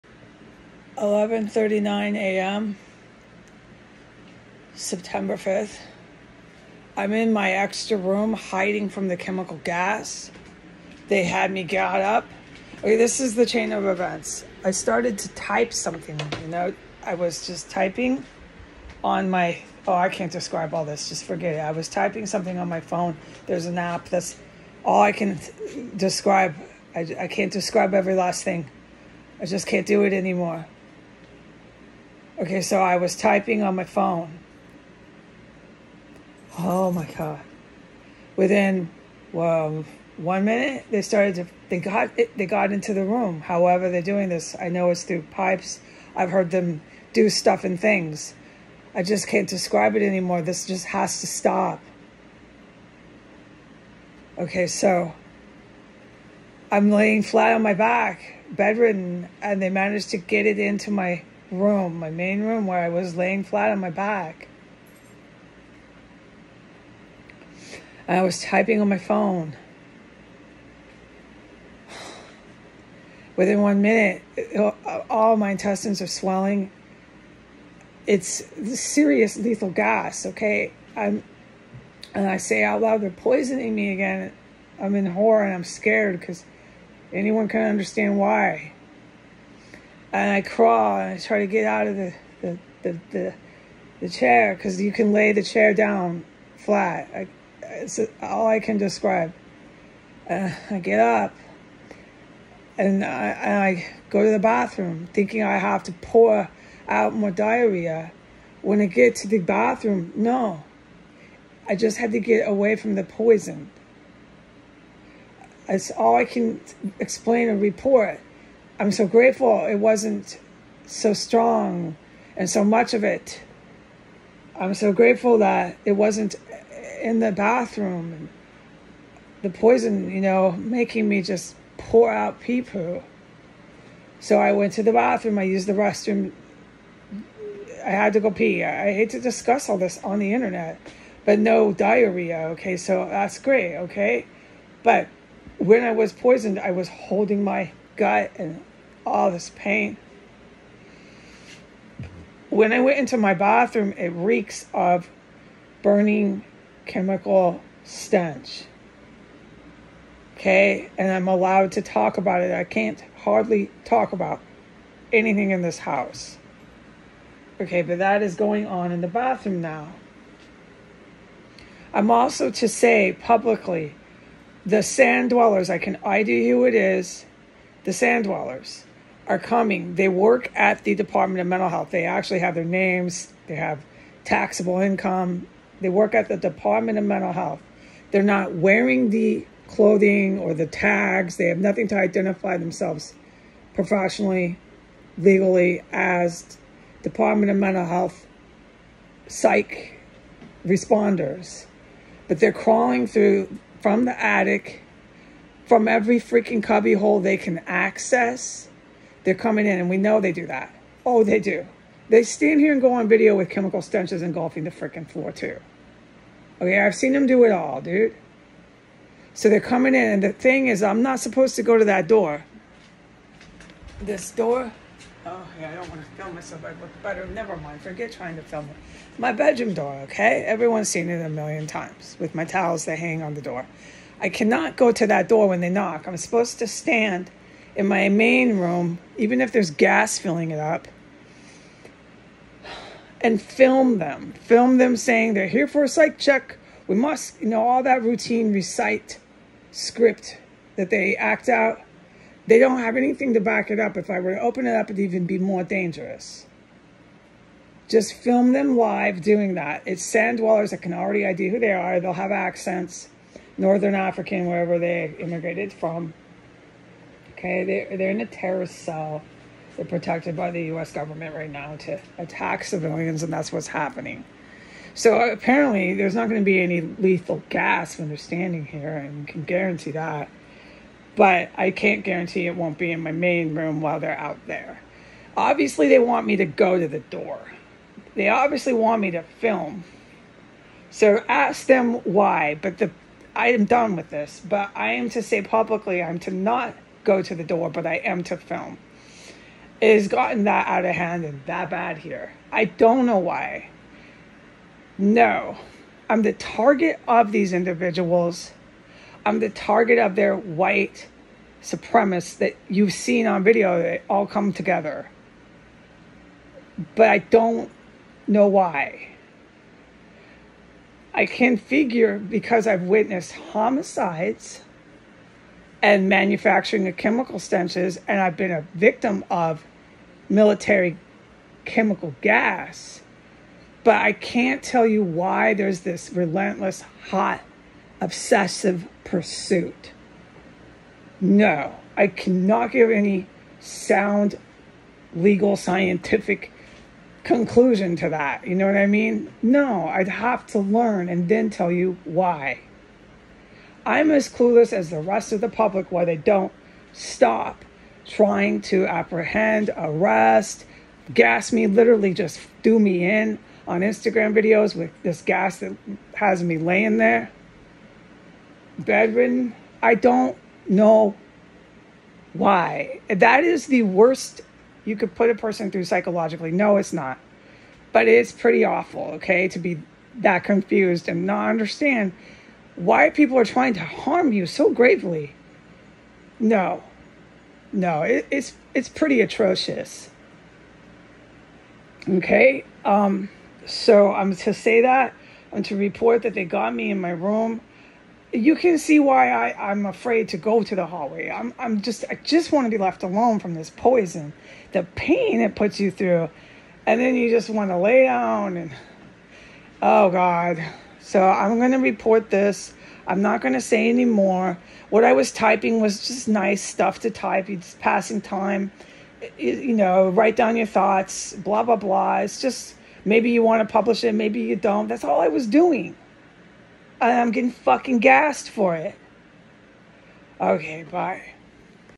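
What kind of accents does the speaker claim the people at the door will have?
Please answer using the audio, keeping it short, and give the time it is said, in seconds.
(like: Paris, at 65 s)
Northern African, at 263 s.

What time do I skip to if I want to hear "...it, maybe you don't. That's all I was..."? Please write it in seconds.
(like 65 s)
424 s.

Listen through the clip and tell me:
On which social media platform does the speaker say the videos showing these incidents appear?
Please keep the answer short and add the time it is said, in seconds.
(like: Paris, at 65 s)
Instagram, at 363 s.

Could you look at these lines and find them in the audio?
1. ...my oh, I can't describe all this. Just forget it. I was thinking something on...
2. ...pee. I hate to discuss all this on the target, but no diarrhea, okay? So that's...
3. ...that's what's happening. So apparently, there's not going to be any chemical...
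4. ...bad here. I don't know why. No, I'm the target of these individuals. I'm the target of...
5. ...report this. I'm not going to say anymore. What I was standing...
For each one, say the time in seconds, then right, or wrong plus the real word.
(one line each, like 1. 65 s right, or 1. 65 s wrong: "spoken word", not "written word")
1. 19 s wrong: "typing", not "thinking"
2. 138 s wrong: "internet", not "target"
3. 273 s wrong: "lethal", not "chemical"
4. 301 s right
5. 411 s wrong: "typing", not "standing".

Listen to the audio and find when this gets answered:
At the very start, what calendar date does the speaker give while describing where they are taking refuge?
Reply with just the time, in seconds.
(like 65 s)
4 s.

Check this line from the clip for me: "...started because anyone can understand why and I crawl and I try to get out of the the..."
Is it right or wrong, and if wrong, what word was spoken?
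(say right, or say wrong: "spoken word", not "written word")
wrong: "scared", not "started".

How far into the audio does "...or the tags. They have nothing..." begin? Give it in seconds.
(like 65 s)
190 s.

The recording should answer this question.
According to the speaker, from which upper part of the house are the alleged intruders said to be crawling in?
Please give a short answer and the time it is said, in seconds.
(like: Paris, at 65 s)
the attic, at 204 s.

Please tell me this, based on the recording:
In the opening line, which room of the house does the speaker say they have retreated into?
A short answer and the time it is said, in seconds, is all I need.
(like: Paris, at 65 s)
extra room, at 7 s.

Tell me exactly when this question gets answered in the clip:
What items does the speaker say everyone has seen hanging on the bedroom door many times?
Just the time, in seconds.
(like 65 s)
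232 s.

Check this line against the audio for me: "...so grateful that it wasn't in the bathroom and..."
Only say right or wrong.
right.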